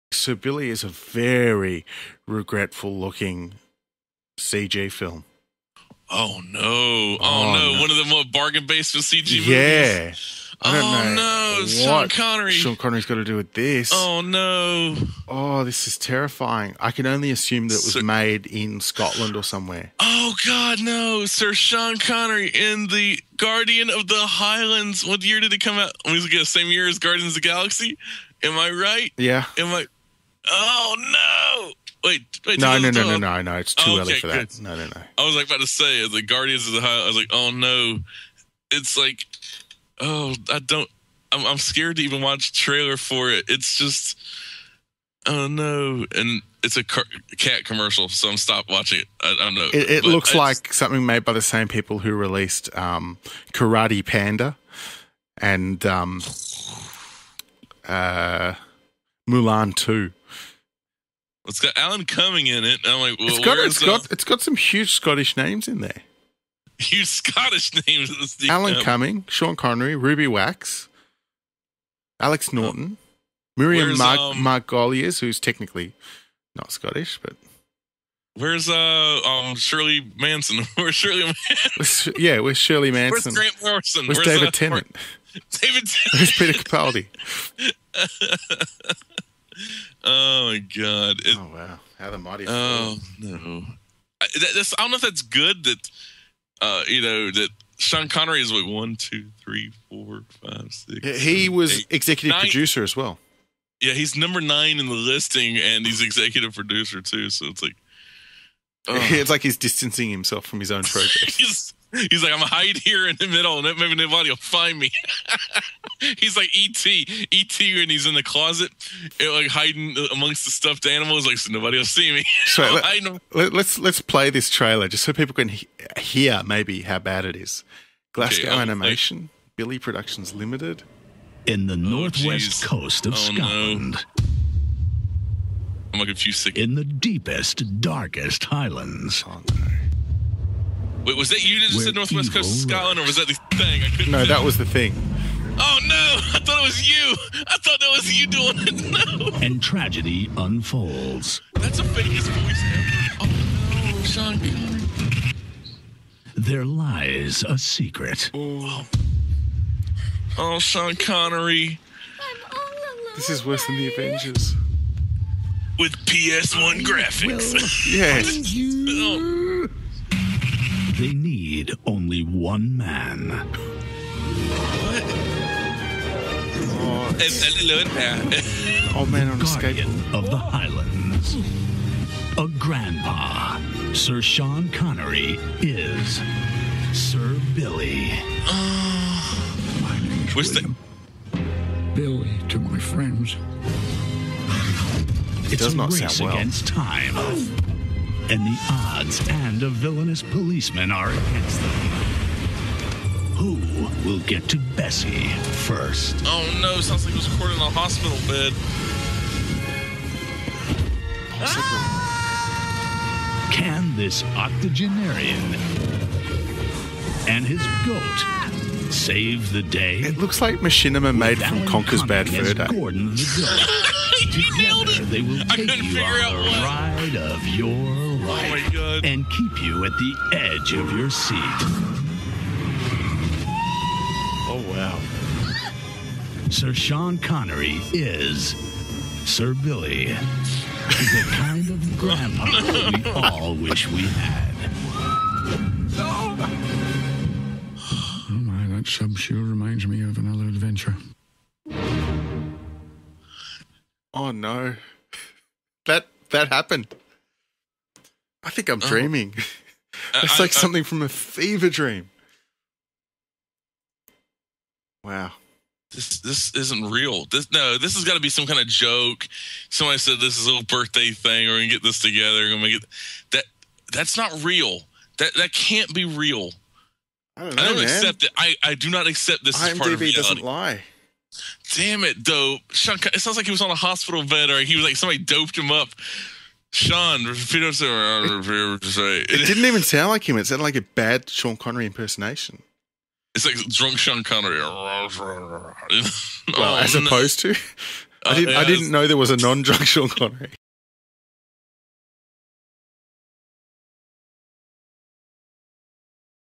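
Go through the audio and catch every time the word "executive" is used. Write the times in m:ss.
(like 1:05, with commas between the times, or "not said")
1:41, 1:46.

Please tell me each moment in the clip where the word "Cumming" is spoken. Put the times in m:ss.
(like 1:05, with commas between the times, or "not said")
1:02, 1:08.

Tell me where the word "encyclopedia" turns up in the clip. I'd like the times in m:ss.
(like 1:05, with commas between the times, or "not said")
not said.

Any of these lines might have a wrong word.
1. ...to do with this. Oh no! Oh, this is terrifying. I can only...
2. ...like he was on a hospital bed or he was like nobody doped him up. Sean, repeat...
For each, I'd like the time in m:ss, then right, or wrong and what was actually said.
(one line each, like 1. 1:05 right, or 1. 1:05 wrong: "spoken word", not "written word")
1. 0:13 right
2. 4:43 wrong: "somebody", not "nobody".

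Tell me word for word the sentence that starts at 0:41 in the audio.
I'm, I'm scared to even watch trailer for it.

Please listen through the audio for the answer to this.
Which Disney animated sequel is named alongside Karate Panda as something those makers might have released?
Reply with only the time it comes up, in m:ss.
0:59.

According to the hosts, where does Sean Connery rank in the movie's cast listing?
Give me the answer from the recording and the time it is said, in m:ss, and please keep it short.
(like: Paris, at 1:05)
9, at 1:44.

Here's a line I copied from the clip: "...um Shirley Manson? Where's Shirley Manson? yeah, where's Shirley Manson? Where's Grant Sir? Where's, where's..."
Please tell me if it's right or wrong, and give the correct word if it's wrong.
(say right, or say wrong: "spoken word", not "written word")
wrong: "Morrison", not "Sir".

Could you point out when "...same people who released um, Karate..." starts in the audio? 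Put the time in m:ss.
0:51.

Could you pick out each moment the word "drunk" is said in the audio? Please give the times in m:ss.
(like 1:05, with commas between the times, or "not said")
4:53, 4:59.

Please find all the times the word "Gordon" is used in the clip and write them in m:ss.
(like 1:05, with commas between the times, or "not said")
3:42.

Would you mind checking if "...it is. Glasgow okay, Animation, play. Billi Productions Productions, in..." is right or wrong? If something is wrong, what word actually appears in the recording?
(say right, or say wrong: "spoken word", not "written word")
wrong: "Limited", not "Productions".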